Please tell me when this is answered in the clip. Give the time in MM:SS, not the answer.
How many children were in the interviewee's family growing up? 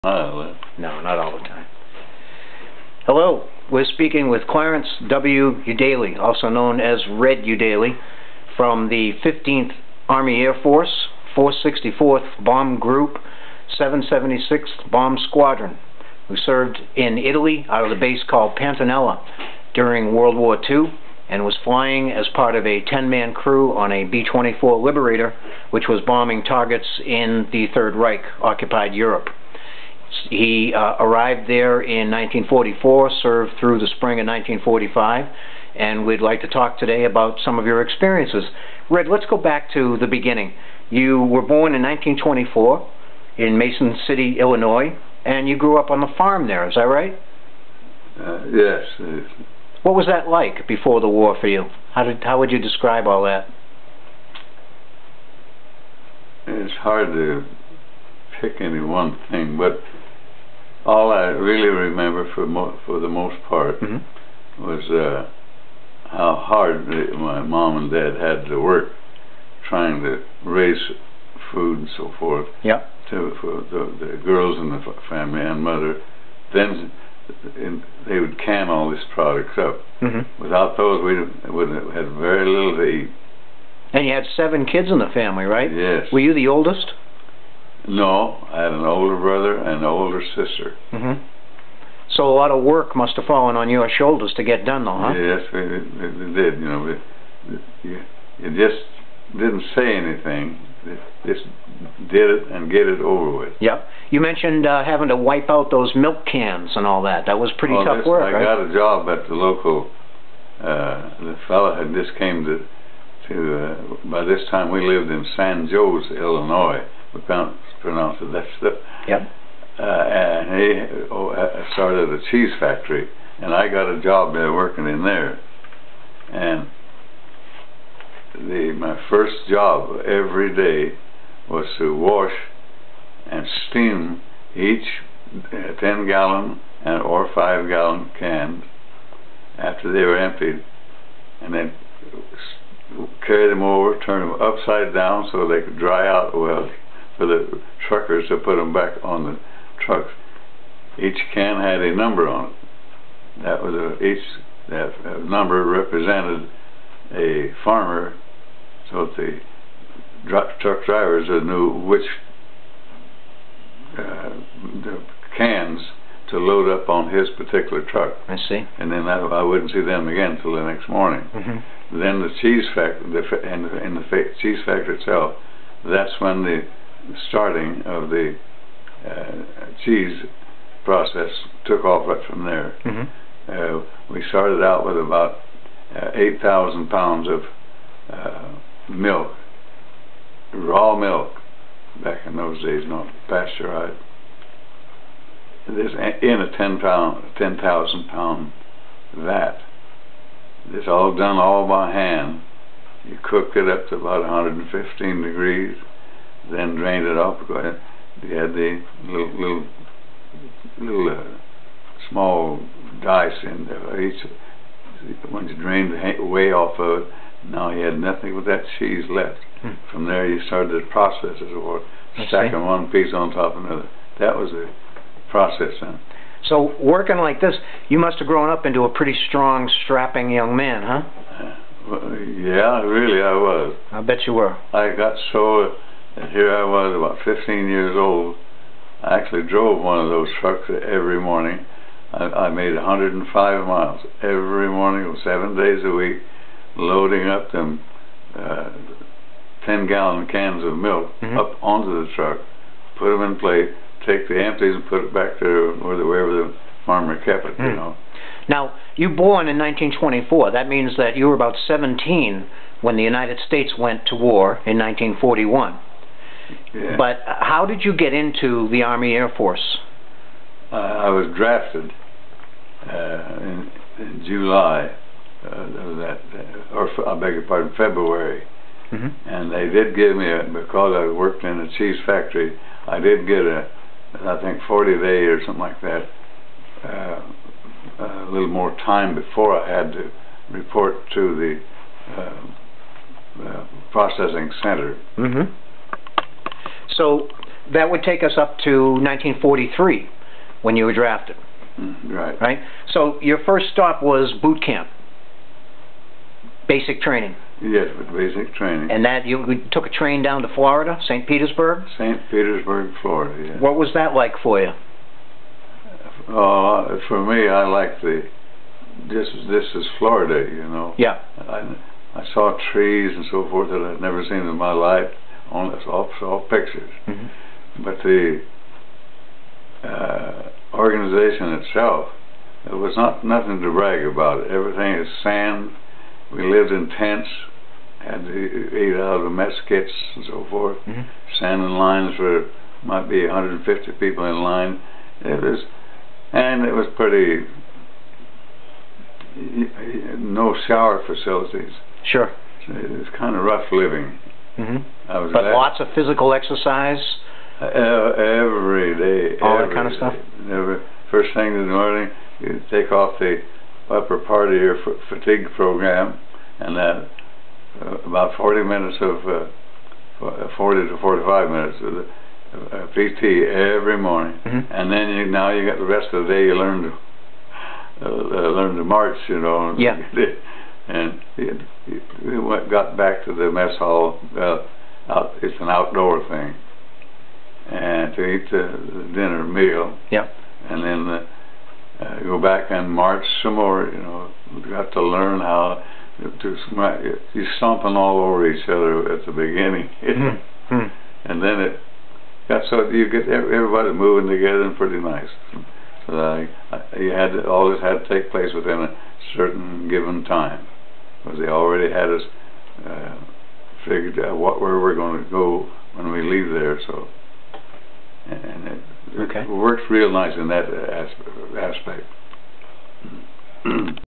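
01:24.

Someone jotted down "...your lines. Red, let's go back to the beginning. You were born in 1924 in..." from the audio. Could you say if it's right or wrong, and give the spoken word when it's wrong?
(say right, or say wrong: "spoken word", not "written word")
wrong: "experiences", not "lines".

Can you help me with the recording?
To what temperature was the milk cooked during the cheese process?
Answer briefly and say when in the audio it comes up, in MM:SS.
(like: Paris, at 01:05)
115 degrees, at 03:24.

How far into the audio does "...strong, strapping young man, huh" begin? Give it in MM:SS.
03:49.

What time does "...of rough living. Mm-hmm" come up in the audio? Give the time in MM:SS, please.
05:53.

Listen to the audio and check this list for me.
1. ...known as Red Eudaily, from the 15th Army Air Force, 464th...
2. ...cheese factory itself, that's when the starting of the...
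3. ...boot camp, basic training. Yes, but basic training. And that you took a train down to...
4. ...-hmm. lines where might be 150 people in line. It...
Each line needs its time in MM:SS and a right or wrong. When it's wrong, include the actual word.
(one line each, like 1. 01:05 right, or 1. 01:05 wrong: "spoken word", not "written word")
1. 00:06 right
2. 02:54 right
3. 05:04 right
4. 05:41 right.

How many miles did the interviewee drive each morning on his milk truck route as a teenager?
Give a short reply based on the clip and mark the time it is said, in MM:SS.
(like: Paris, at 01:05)
105 miles, at 04:02.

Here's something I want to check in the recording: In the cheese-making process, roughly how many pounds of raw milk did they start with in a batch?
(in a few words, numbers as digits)
8,000 pounds.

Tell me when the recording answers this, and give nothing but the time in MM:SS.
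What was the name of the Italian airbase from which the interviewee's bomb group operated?
00:18.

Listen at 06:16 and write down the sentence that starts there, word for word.
You learn to uh, learn to march, you know.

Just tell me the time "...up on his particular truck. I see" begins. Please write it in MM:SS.
02:46.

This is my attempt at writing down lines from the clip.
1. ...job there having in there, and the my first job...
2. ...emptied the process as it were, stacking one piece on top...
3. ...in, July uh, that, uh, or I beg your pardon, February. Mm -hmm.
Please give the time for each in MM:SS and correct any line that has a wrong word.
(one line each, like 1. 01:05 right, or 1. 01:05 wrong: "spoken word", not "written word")
1. 02:04 wrong: "working", not "having"
2. 03:40 wrong: "started", not "emptied"
3. 04:33 right.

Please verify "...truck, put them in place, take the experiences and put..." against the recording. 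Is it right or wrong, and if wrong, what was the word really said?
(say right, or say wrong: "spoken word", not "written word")
wrong: "empties", not "experiences".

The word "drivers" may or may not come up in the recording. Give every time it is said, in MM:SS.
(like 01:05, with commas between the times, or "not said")
02:40.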